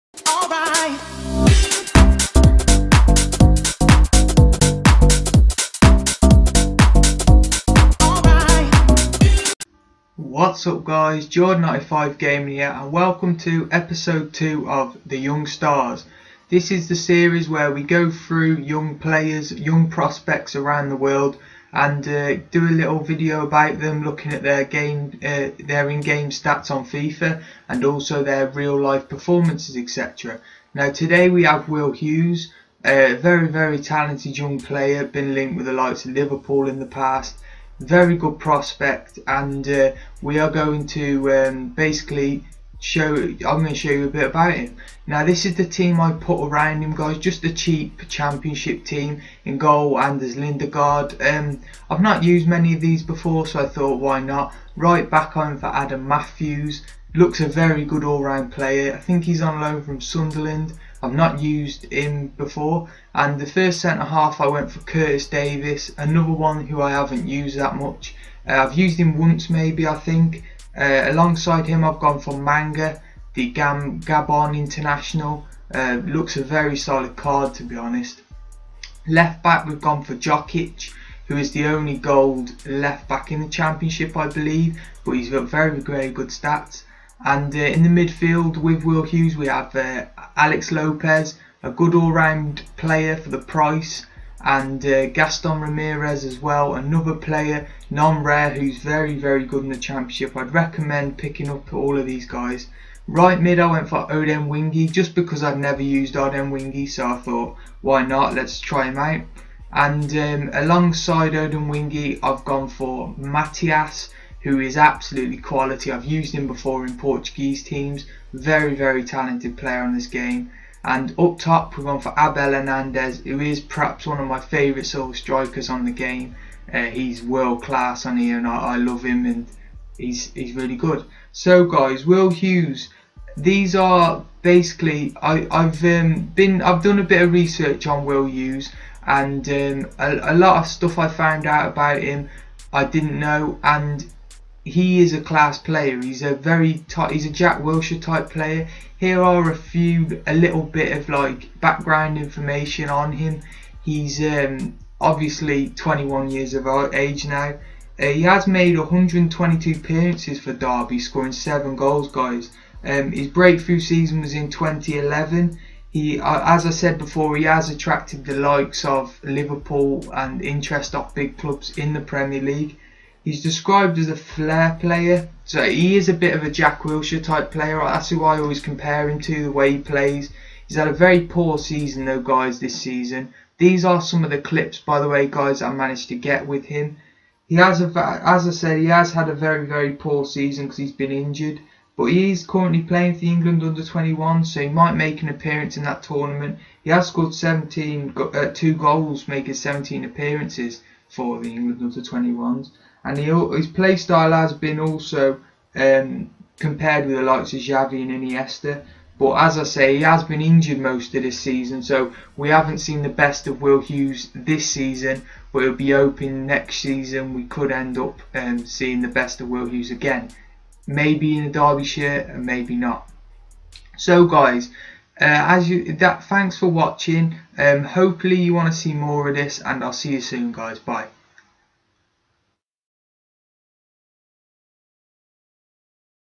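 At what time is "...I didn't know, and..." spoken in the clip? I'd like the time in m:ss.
2:22.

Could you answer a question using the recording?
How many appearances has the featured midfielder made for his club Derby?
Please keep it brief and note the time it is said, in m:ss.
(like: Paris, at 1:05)
122, at 2:38.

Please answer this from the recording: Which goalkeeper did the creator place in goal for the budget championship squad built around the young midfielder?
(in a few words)
Anders Lindegaard.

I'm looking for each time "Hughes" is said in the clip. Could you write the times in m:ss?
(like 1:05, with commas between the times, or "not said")
0:31, 1:29, 2:12, 2:18, 3:33, 3:39.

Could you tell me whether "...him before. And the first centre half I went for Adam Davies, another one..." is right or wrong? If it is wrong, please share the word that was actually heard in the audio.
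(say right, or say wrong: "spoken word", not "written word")
wrong: "Curtis", not "Adam".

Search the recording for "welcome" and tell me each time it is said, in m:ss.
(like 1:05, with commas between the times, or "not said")
0:12.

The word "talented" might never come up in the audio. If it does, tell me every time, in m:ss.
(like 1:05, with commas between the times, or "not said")
0:33, 1:59.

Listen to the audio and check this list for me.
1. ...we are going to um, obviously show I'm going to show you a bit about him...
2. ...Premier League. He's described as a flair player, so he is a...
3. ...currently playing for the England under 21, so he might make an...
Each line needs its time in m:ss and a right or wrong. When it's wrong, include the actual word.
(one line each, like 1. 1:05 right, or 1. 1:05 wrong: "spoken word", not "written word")
1. 0:40 wrong: "basically", not "obviously"
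2. 2:51 right
3. 3:12 right.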